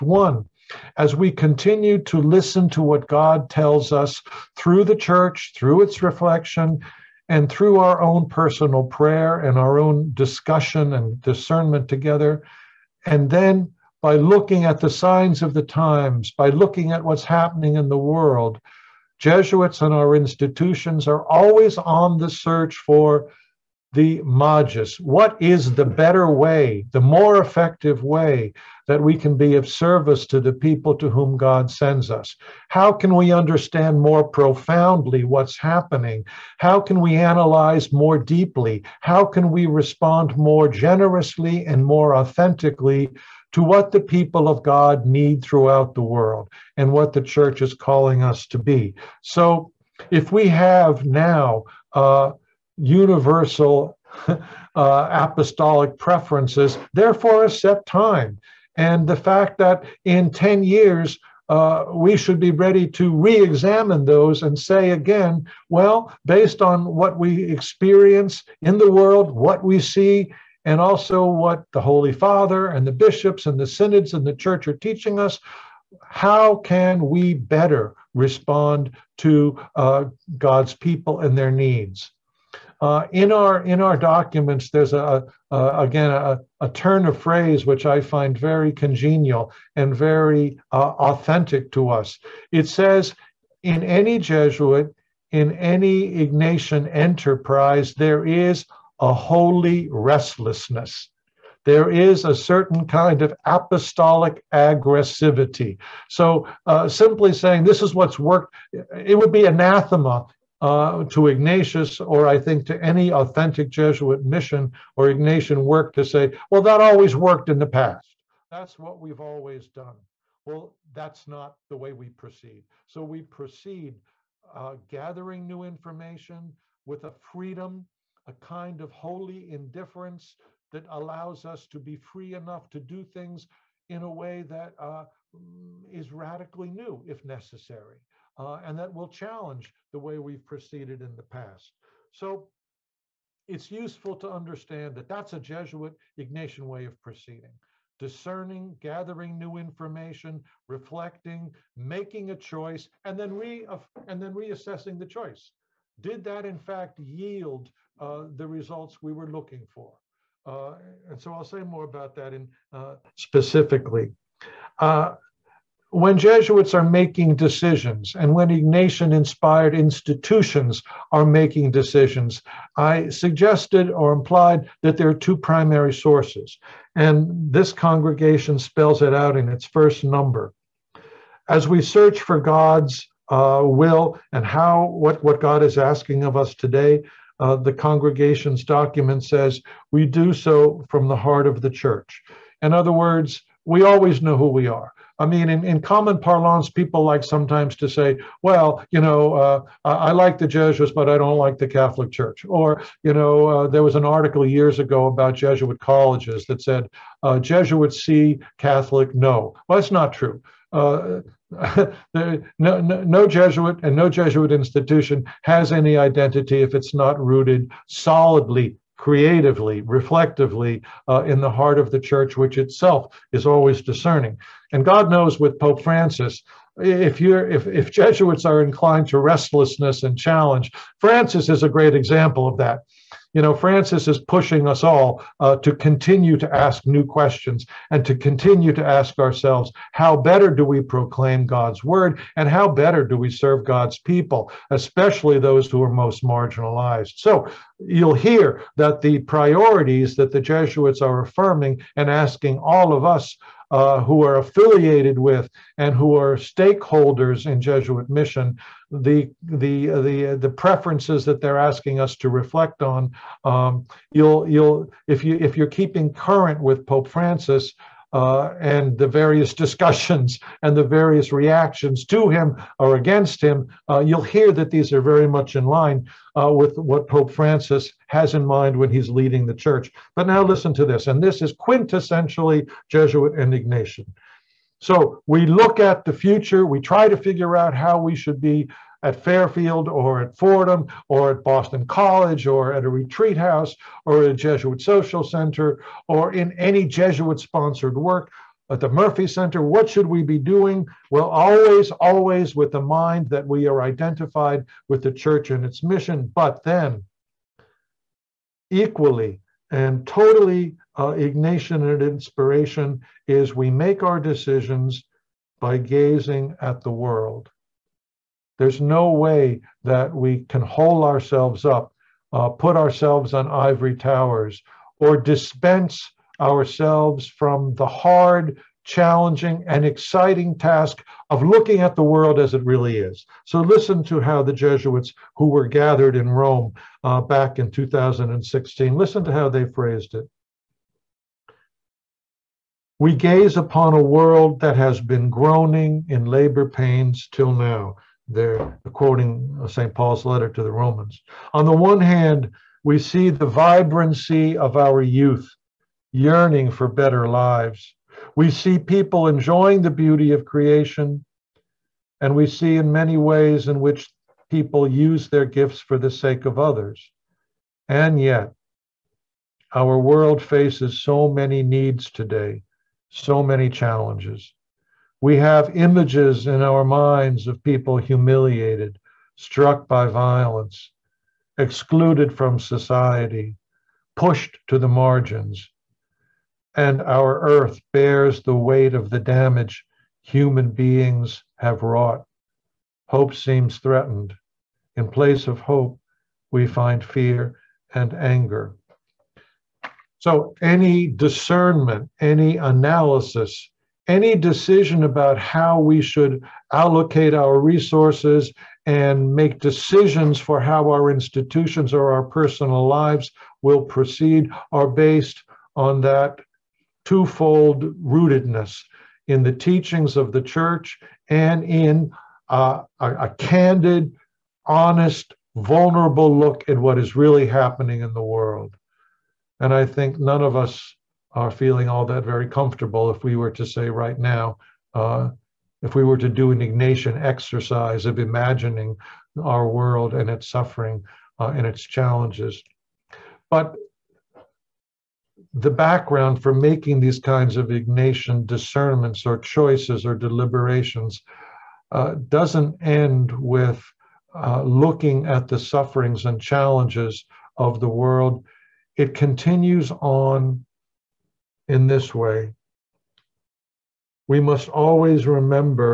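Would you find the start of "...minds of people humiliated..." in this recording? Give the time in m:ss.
6:16.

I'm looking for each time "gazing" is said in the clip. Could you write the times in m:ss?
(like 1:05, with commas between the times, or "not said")
5:15.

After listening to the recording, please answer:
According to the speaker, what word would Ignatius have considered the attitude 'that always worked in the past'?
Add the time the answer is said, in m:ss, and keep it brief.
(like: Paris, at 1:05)
anathema, at 1:49.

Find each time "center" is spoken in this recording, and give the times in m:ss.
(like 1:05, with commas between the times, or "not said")
4:55, 4:59.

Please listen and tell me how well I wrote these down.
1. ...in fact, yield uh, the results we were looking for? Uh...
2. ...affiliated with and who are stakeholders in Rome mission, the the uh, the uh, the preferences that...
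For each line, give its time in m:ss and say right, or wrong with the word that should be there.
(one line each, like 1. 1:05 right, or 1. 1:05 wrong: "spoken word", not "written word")
1. 2:36 right
2. 4:14 wrong: "Jesuit", not "Rome".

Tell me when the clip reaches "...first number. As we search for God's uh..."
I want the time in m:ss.
2:59.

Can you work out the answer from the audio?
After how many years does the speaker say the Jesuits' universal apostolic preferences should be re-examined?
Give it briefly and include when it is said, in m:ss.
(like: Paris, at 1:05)
10, at 1:00.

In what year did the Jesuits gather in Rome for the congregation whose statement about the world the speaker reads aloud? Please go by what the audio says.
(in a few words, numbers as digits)
2016.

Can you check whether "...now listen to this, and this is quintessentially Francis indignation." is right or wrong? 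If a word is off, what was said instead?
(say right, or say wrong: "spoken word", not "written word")
wrong: "Jesuit", not "Francis".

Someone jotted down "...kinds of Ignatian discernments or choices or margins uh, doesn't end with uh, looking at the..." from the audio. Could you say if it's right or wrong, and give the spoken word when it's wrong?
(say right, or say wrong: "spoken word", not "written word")
wrong: "deliberations", not "margins".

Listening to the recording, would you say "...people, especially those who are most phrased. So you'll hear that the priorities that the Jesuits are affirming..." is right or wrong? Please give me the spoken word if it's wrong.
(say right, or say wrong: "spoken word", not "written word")
wrong: "marginalized", not "phrased".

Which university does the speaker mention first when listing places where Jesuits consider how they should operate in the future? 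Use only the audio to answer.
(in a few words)
Fairfield.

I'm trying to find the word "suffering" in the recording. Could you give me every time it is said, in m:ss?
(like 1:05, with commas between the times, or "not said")
7:20, 7:35.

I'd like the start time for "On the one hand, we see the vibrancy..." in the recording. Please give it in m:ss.
5:51.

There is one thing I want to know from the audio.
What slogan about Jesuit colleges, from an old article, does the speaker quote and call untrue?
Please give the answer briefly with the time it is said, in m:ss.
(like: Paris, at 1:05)
Jesuits see, Catholic no, at 3:27.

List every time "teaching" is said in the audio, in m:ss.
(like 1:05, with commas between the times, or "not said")
1:14, 6:59.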